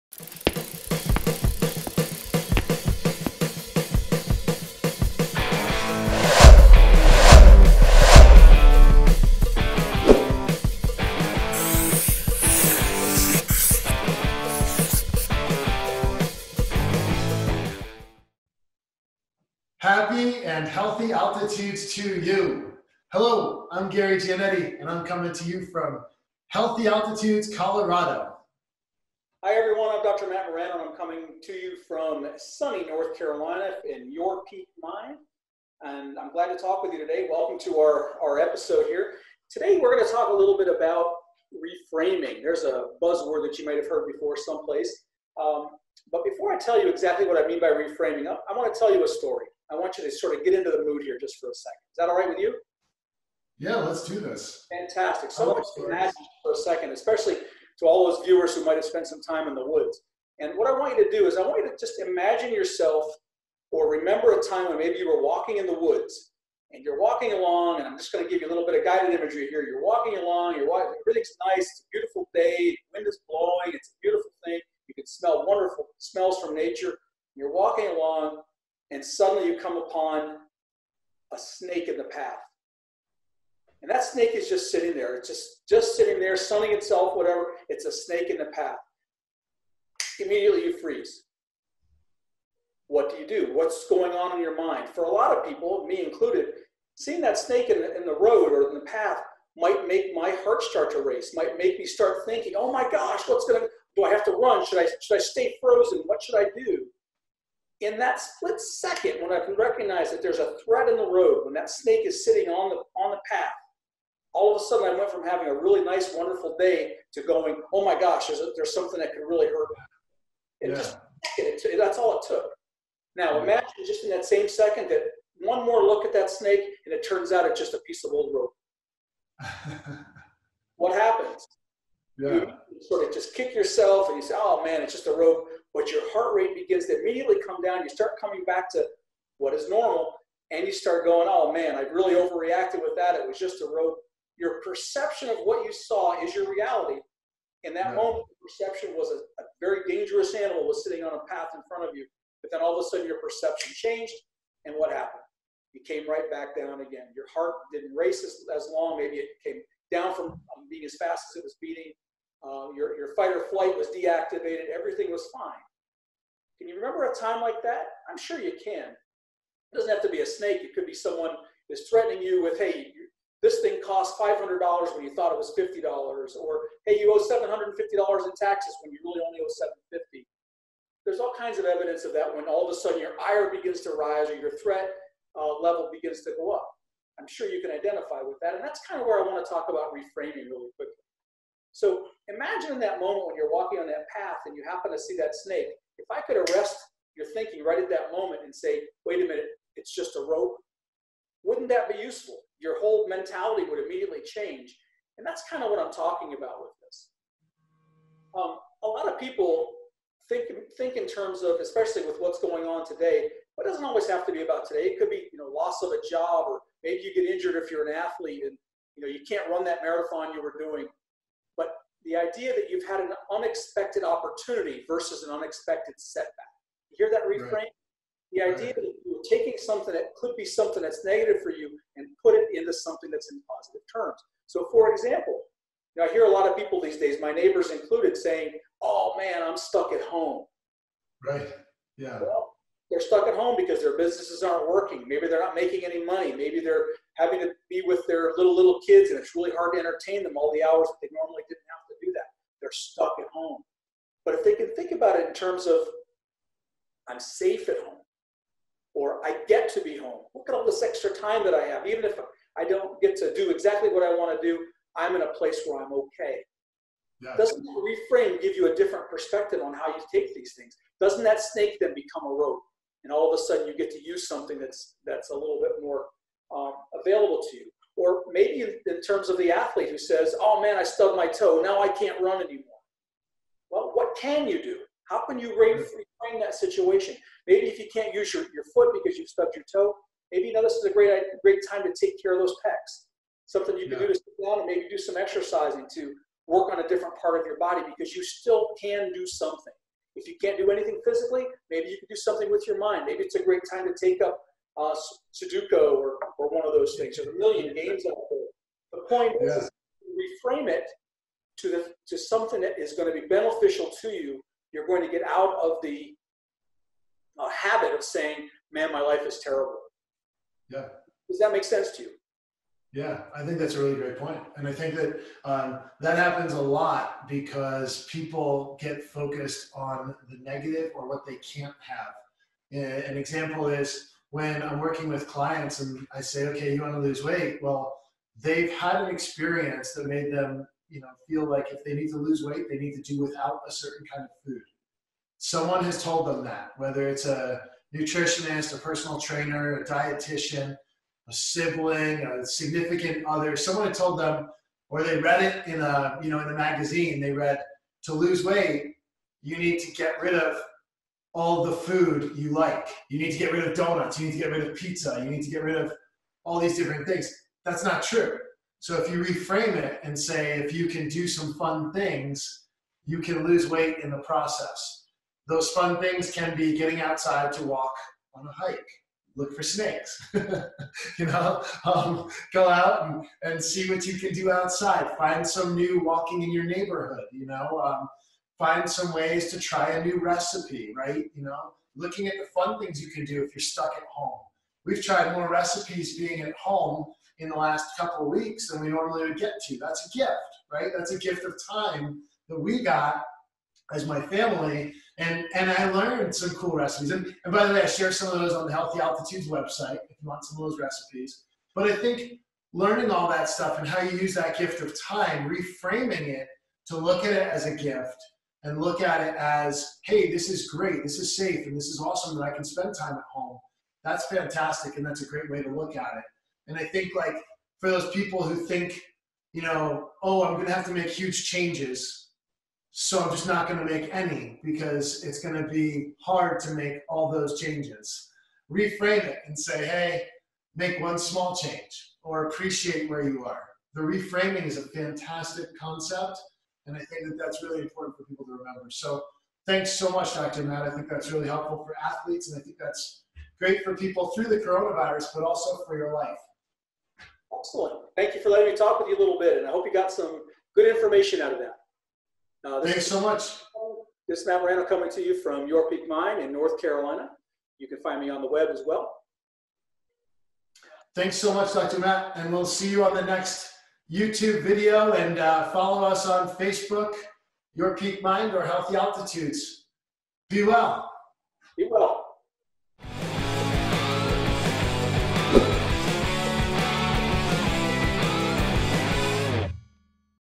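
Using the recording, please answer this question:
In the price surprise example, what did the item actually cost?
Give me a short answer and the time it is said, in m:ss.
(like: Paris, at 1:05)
$500, at 2:54.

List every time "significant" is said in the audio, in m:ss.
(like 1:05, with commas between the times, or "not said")
5:52.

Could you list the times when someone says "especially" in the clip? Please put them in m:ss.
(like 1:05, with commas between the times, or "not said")
0:56, 3:31.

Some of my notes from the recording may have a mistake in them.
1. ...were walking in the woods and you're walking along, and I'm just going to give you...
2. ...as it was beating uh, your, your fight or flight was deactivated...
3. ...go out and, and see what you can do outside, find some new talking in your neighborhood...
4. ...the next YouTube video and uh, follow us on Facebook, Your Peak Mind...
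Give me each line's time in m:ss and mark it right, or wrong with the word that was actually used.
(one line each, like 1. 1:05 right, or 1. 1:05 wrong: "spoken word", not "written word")
1. 1:05 right
2. 2:41 right
3. 6:22 wrong: "walking", not "talking"
4. 7:53 right.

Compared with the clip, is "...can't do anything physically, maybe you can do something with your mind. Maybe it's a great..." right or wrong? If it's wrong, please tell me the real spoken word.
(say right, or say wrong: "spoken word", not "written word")
right.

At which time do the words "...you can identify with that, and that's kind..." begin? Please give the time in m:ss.
3:07.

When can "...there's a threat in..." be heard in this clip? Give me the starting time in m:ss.
1:50.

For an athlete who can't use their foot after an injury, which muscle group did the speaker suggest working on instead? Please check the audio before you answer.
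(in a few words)
pecs.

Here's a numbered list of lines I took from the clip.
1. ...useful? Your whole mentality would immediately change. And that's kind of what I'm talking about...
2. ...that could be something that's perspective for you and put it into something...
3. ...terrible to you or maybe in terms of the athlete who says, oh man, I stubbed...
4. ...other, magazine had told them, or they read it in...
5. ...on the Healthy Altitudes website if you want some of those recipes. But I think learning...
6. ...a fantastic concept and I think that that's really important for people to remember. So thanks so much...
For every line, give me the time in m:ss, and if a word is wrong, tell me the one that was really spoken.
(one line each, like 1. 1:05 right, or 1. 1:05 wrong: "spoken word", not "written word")
1. 3:22 right
2. 3:49 wrong: "negative", not "perspective"
3. 4:37 wrong: "available", not "terrible"
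4. 5:53 wrong: "someone", not "magazine"
5. 6:48 right
6. 7:24 right.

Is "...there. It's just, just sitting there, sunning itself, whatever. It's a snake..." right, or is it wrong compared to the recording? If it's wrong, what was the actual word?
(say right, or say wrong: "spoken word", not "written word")
right.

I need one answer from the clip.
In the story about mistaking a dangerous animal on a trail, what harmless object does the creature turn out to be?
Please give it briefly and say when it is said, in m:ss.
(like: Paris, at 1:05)
old rope, at 2:08.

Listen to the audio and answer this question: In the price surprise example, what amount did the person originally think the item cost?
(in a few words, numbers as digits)
$50.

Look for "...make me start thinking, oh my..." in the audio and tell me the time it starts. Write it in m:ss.
1:41.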